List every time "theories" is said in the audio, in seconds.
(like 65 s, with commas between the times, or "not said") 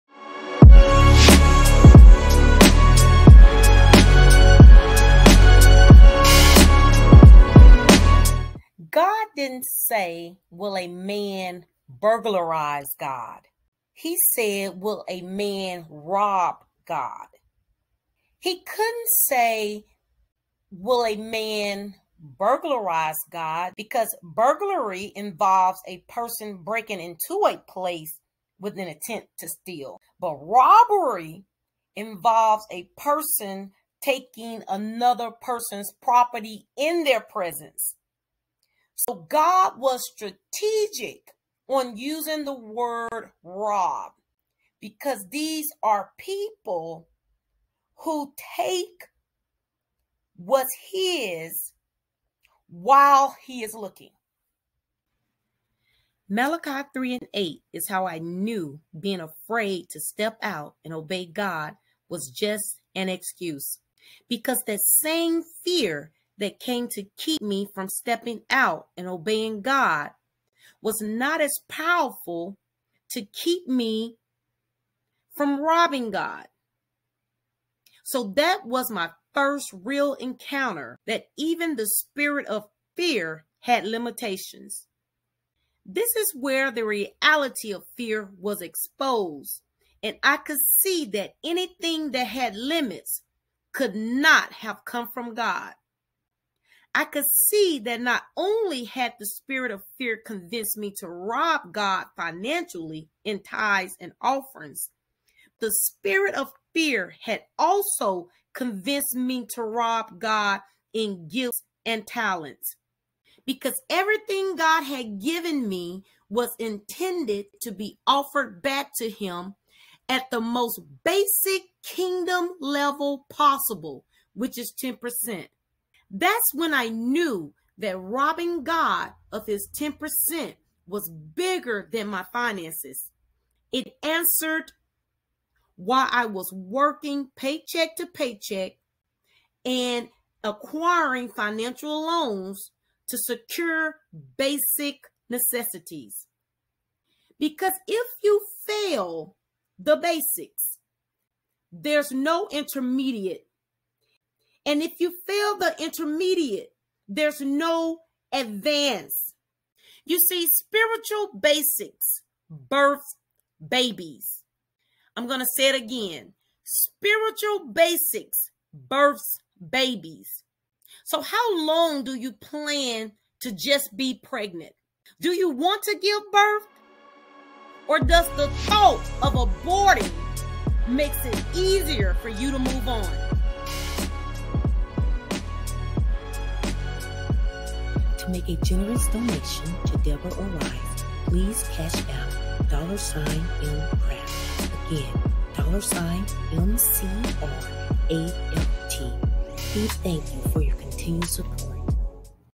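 not said.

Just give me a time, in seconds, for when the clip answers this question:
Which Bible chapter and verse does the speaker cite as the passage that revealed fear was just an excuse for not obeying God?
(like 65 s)
56 s.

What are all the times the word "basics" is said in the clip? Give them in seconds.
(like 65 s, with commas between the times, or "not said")
121 s, 144 s, 149 s, 161 s, 167 s.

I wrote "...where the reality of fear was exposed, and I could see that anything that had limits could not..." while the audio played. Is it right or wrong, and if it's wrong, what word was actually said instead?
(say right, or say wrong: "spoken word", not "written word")
right.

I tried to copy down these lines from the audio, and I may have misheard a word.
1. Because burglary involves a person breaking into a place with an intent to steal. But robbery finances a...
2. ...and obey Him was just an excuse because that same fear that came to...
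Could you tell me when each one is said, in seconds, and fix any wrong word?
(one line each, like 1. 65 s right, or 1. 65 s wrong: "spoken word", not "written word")
1. 23 s wrong: "involves", not "finances"
2. 60 s wrong: "God", not "Him".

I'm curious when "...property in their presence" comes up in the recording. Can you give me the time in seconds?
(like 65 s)
36 s.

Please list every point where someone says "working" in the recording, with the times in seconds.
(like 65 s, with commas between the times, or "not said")
136 s.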